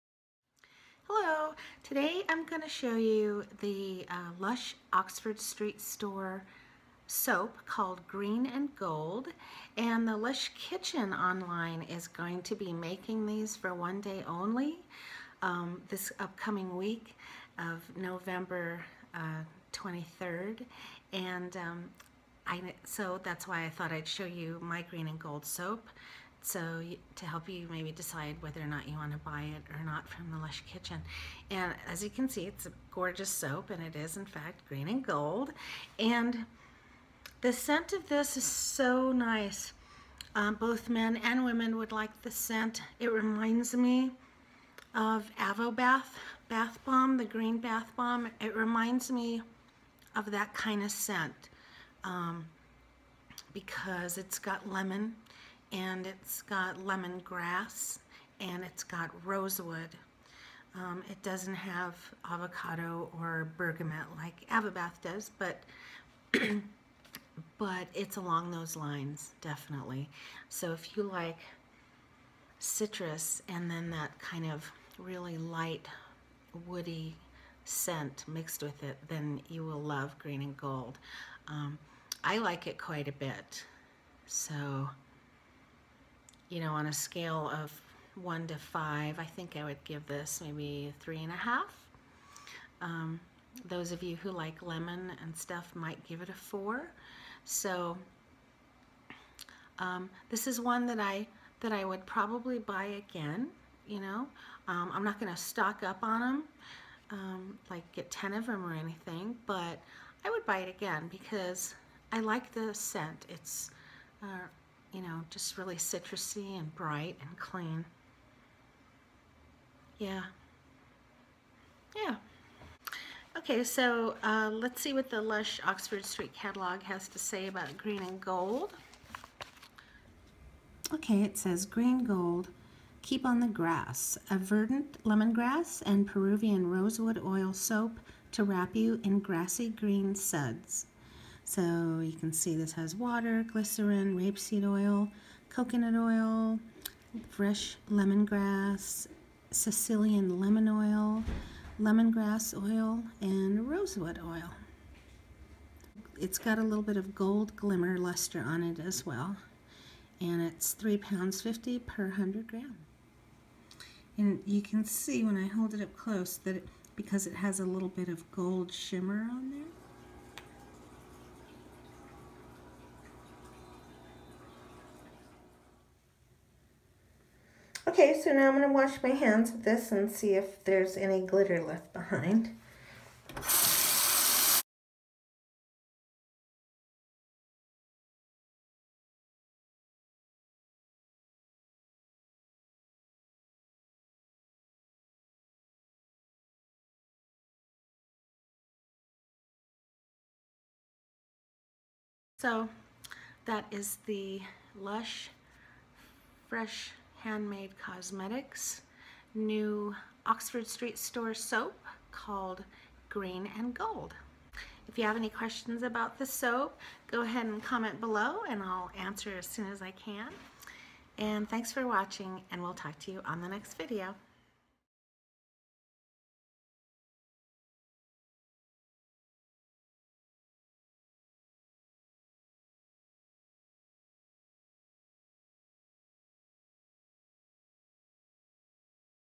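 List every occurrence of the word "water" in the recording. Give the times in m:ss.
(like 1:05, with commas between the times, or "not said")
2:22.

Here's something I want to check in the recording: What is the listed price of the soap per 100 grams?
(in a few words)
£3.50.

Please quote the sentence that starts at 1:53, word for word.
It's uh, you know, just really citrusy and bright and clean.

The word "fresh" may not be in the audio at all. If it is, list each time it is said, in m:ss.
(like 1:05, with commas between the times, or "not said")
2:27, 3:26.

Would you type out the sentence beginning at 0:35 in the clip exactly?
And the scent of this is so nice.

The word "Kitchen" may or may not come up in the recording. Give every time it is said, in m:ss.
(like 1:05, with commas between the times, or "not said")
0:10, 0:30.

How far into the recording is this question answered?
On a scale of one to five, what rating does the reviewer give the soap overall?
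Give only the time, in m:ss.
1:30.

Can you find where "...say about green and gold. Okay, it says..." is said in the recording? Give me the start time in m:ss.
2:07.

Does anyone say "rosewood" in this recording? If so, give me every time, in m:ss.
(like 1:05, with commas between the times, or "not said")
0:59, 2:16, 2:33.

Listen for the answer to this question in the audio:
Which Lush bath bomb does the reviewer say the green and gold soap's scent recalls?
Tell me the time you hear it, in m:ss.
0:45.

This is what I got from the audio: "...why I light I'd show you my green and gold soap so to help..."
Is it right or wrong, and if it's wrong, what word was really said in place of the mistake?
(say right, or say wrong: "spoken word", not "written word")
wrong: "thought", not "light".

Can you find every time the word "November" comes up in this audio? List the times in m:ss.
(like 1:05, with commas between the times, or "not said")
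0:17.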